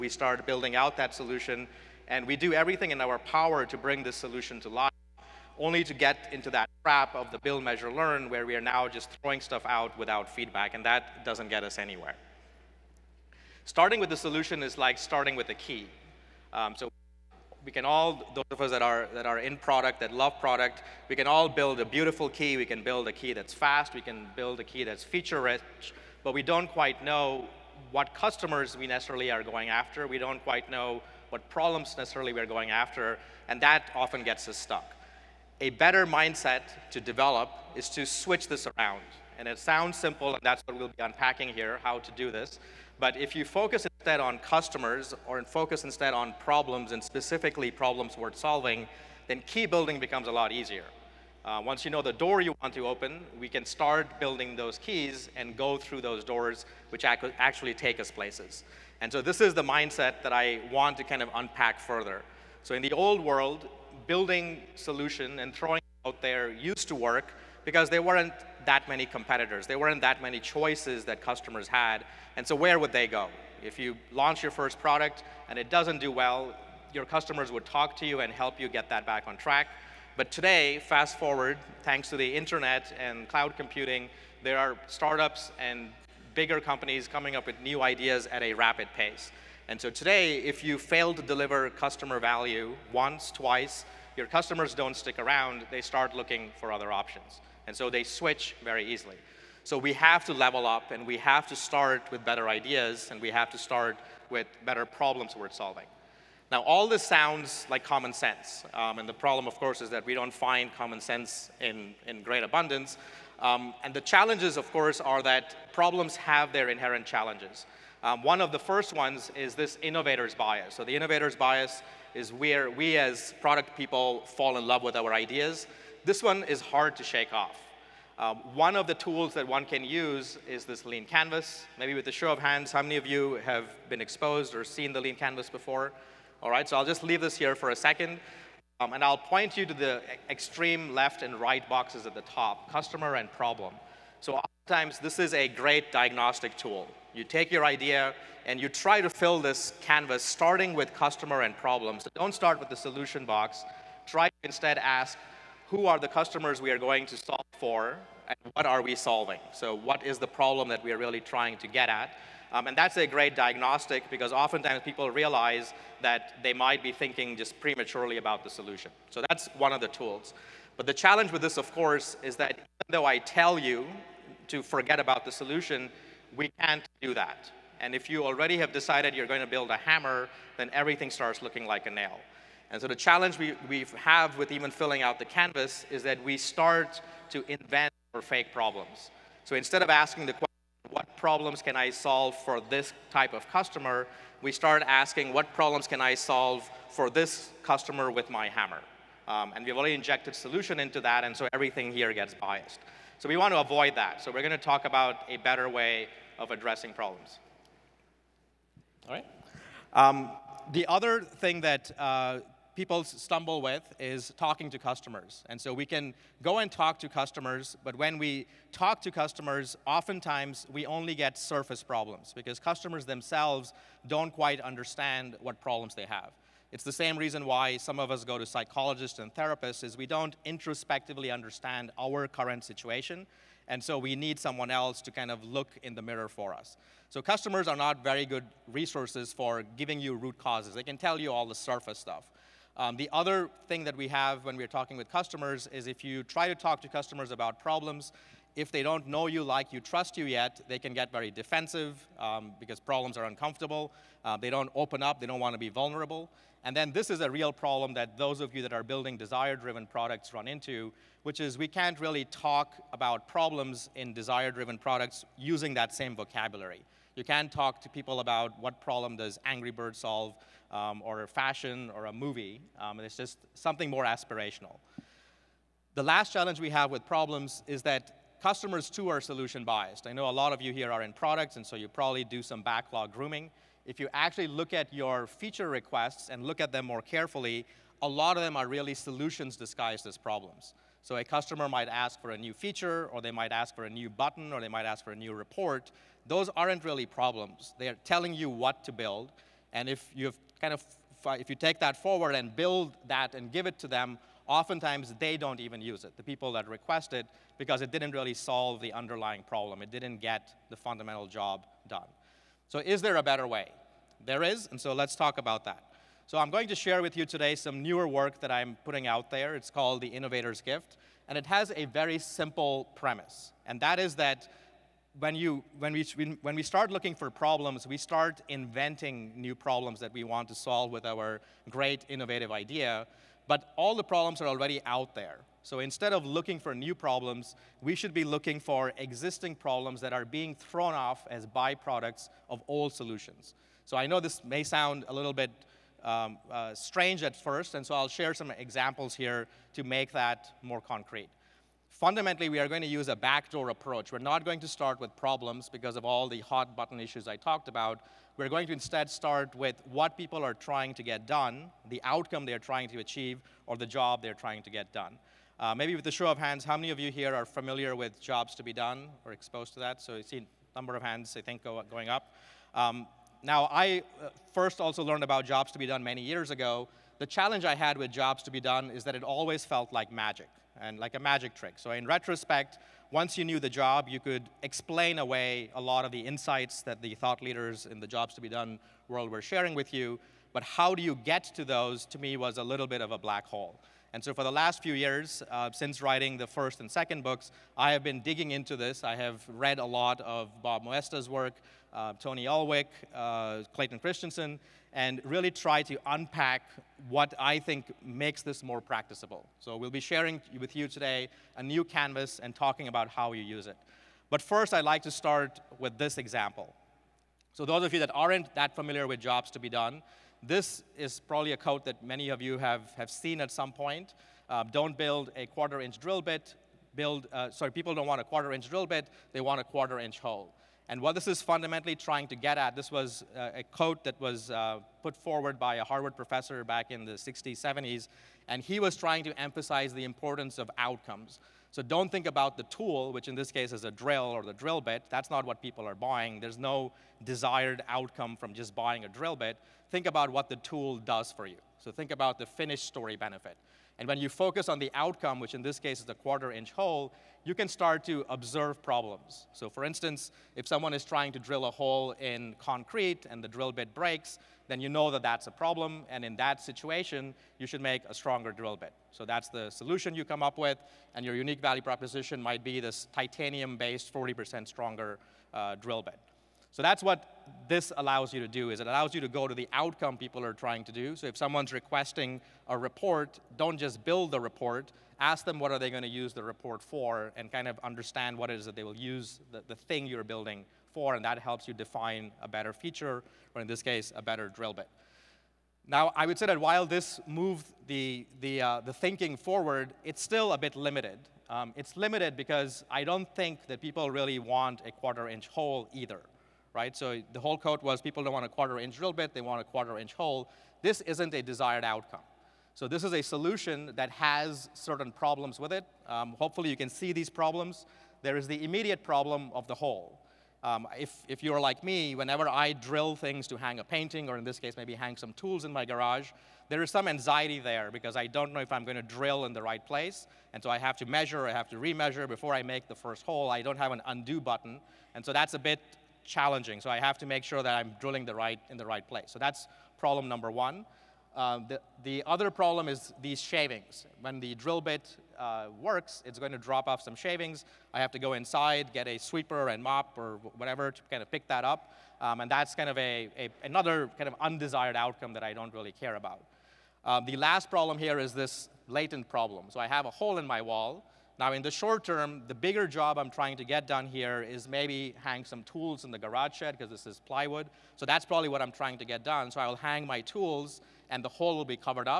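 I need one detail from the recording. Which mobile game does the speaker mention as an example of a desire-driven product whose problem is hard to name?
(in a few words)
Angry Bird.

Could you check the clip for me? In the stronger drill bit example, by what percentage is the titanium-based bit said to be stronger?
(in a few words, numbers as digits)
40%.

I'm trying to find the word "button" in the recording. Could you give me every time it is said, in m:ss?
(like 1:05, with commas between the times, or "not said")
4:54, 5:56, 8:54.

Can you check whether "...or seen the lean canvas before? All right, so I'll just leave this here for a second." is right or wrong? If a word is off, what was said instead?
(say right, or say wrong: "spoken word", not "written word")
right.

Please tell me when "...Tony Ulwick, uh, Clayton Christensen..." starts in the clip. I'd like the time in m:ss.
6:42.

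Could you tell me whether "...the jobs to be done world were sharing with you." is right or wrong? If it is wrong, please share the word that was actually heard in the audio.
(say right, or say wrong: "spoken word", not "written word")
right.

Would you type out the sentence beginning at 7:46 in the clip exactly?
And in that situation, you should make a stronger drill bit.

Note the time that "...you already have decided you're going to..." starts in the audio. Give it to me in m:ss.
2:58.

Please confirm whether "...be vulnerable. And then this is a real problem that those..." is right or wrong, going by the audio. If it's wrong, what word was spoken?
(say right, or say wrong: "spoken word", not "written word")
right.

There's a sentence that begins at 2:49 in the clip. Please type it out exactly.
So that's one of the tools.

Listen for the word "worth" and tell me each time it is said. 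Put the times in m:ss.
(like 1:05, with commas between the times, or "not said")
0:48, 1:45.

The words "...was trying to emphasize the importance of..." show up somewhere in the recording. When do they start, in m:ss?
7:18.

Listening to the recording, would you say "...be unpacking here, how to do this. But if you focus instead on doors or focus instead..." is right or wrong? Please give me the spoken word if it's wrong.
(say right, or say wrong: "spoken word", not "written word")
wrong: "customers", not "doors".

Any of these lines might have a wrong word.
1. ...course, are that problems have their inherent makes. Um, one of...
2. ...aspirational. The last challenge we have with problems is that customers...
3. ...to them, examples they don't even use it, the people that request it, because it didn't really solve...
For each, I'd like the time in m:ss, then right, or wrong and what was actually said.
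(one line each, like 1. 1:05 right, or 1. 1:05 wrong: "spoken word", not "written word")
1. 1:54 wrong: "challenges", not "makes"
2. 4:34 right
3. 5:03 wrong: "oftentimes", not "examples".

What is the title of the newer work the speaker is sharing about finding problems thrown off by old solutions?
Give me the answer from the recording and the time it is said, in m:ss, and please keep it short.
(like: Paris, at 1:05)
The Innovator's Gift, at 5:19.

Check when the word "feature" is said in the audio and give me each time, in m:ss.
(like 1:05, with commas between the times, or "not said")
0:25, 4:45, 4:52, 8:12.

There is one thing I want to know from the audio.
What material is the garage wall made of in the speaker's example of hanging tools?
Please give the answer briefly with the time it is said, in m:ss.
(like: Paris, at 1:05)
plywood, at 9:27.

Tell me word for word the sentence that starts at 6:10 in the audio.
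So you see a number of hands, I think, go, going up.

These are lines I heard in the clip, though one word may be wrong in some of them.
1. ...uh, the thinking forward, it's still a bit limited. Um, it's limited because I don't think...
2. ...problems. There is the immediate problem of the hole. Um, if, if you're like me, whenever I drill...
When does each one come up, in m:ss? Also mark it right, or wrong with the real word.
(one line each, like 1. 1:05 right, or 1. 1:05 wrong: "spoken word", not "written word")
1. 8:18 right
2. 8:37 right.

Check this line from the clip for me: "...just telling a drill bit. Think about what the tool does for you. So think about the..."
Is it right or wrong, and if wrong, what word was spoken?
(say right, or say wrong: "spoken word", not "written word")
wrong: "buying", not "telling".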